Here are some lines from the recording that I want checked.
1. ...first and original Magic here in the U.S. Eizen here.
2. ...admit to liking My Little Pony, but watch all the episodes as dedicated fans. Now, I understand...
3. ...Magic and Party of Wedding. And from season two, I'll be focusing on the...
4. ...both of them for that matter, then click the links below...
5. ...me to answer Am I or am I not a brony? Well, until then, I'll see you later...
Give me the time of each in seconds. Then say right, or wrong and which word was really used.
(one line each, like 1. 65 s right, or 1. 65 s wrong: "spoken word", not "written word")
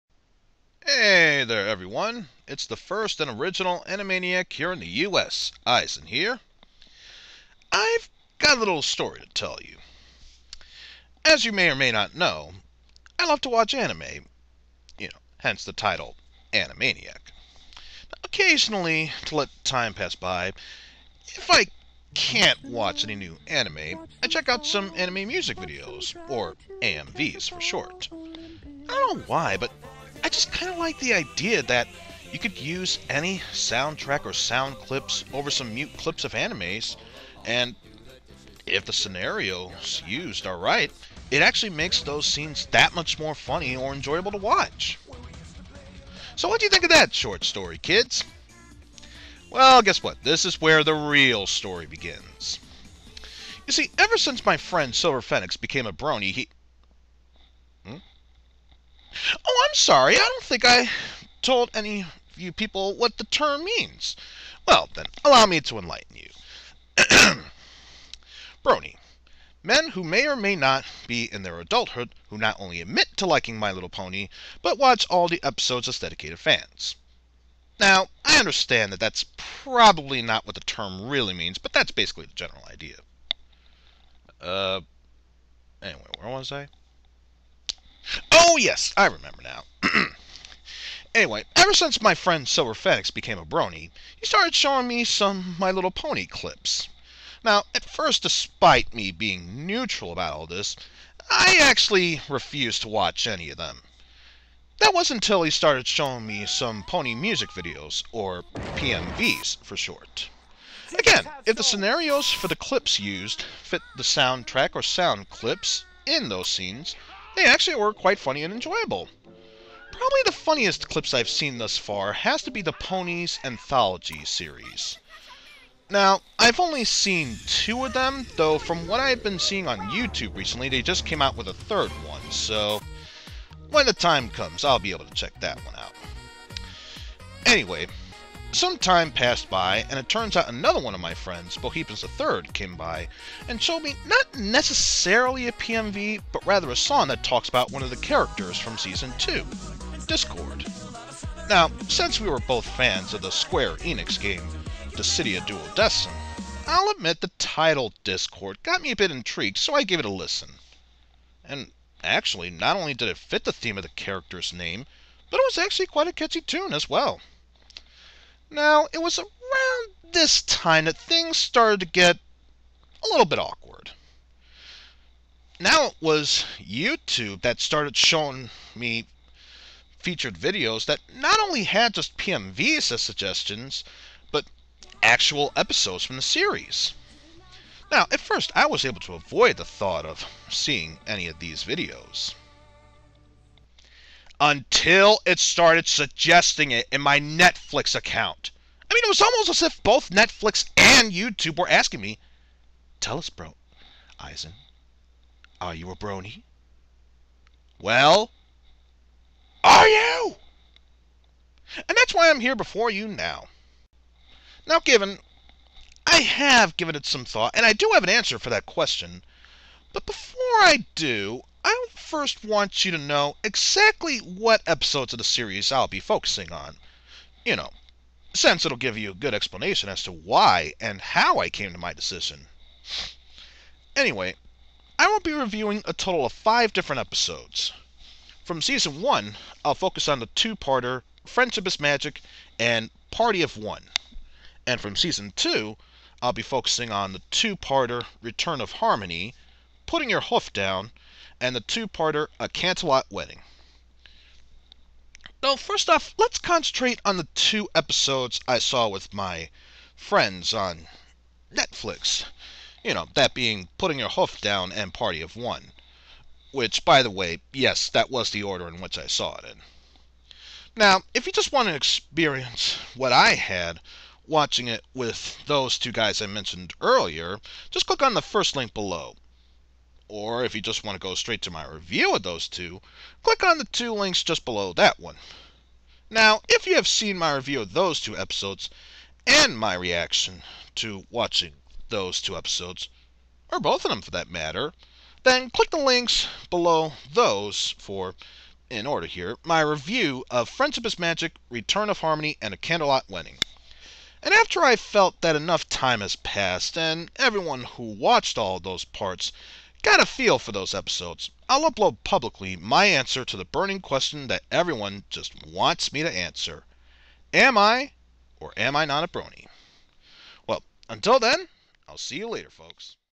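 1. 2 s wrong: "Animeniac", not "Magic"
2. 72 s right
3. 241 s wrong: "One", not "Wedding"
4. 293 s right
5. 315 s right.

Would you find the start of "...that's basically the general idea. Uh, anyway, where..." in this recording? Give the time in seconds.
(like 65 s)
81 s.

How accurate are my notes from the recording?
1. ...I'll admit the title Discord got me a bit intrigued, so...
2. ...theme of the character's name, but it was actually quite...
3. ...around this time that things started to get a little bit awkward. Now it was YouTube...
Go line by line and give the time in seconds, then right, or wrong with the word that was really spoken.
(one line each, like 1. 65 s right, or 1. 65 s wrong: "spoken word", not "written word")
1. 156 s right
2. 163 s right
3. 169 s right.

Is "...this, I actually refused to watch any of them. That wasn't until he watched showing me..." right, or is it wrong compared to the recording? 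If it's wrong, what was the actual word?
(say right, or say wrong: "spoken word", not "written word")
wrong: "started", not "watched".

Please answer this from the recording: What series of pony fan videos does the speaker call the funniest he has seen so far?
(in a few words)
Ponies Anthology.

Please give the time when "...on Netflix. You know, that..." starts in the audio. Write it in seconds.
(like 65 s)
260 s.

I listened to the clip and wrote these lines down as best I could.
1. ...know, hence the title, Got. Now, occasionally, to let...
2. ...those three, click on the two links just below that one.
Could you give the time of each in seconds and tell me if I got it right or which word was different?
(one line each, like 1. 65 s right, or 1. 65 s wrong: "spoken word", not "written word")
1. 15 s wrong: "Animeniac", not "Got"
2. 282 s wrong: "two", not "three".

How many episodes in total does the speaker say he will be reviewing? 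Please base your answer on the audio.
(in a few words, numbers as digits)
5.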